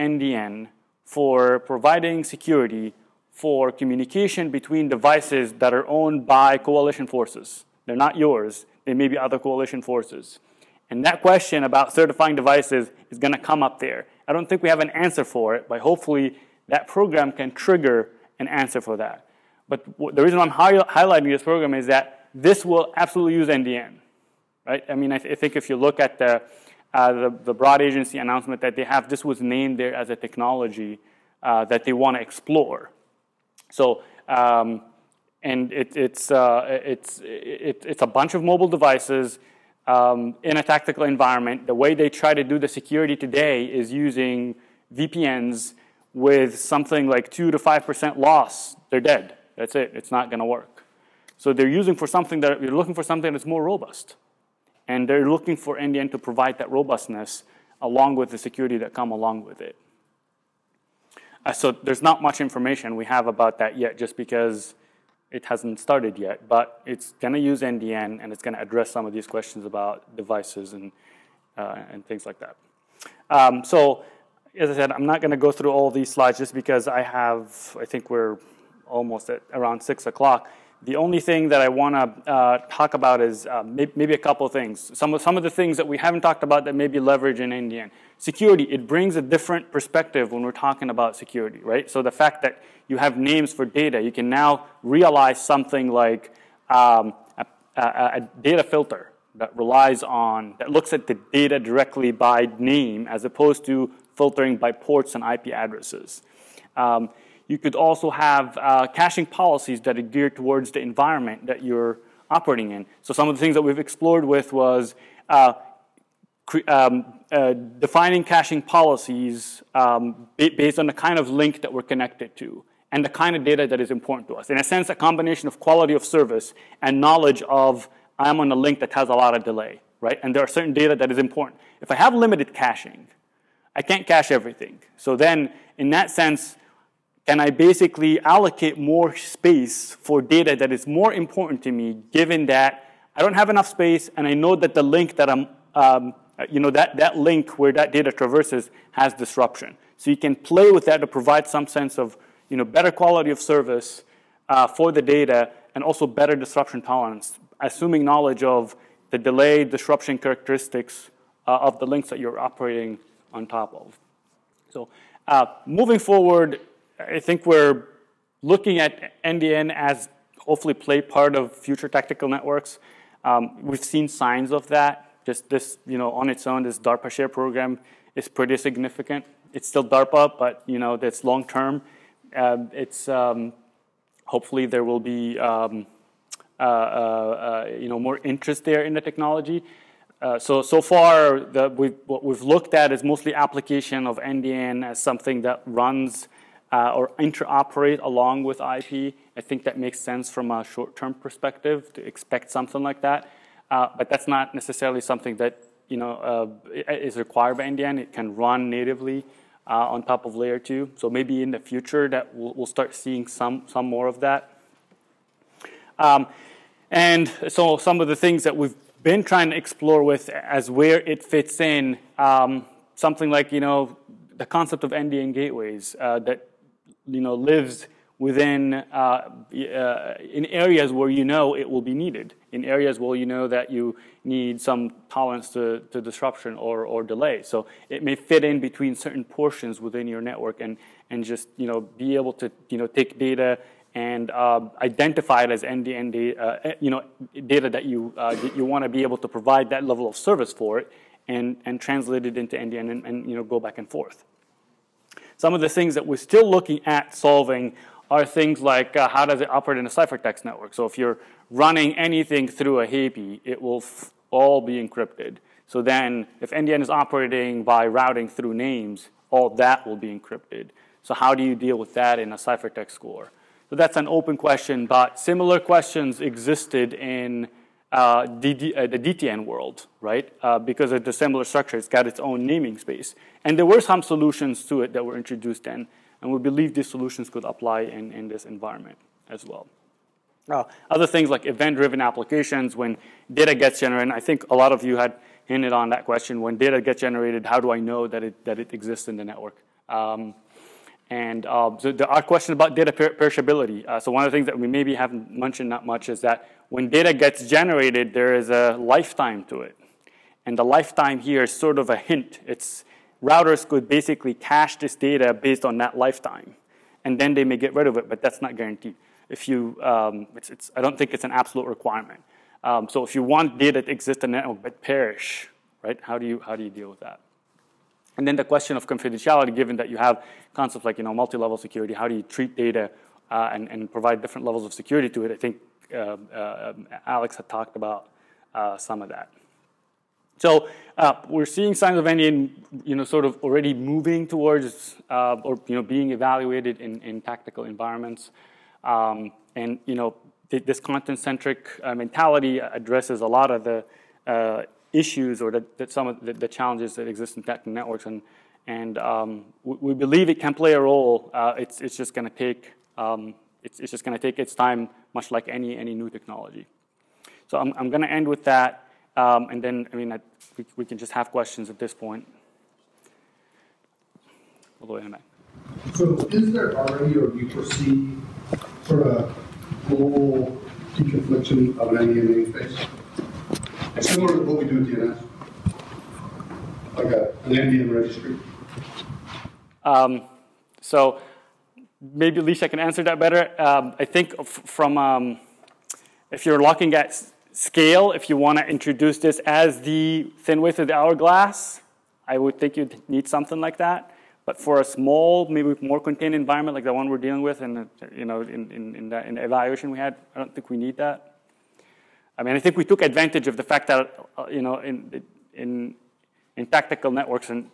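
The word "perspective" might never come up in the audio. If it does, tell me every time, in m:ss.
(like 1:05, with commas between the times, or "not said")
1:29, 3:21.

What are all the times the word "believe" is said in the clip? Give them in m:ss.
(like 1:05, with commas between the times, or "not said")
4:46, 5:59.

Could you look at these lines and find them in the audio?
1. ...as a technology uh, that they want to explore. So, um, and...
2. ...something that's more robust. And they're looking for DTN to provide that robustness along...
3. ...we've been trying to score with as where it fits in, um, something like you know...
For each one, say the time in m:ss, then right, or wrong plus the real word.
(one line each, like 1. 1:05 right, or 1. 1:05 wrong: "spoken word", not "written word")
1. 0:30 right
2. 0:53 wrong: "NDN", not "DTN"
3. 3:38 wrong: "explore", not "score".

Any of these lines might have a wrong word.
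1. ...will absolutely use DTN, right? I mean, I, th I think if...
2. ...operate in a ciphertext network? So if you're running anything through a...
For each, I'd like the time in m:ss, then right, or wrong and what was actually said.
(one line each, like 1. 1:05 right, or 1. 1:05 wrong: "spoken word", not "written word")
1. 0:22 wrong: "NDN", not "DTN"
2. 4:19 right.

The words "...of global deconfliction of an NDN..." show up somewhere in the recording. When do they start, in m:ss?
6:19.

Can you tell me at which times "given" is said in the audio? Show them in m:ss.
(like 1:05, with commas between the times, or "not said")
2:22, 5:29.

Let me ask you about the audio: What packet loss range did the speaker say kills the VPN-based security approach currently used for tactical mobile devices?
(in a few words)
2 to 5%.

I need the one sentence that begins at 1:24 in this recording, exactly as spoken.
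Some of, some of the things that we haven't talked about that maybe leverage in NDN.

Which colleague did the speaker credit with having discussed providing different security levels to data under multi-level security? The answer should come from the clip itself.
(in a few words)
Alex.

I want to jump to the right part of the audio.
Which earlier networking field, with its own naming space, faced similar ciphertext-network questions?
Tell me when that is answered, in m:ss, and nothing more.
4:38.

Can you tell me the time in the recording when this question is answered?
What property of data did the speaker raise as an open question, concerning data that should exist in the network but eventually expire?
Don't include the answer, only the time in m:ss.
5:03.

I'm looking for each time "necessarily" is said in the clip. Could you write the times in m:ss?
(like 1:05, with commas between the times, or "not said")
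3:24.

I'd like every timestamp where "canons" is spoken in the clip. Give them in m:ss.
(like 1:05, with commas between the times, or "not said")
not said.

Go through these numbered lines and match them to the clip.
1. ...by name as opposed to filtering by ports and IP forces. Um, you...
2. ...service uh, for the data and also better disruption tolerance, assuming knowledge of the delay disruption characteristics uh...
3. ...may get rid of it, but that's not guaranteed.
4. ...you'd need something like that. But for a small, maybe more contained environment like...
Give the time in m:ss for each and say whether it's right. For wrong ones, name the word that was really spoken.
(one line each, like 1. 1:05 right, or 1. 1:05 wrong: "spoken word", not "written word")
1. 1:42 wrong: "addresses", not "forces"
2. 2:33 right
3. 5:17 right
4. 6:42 right.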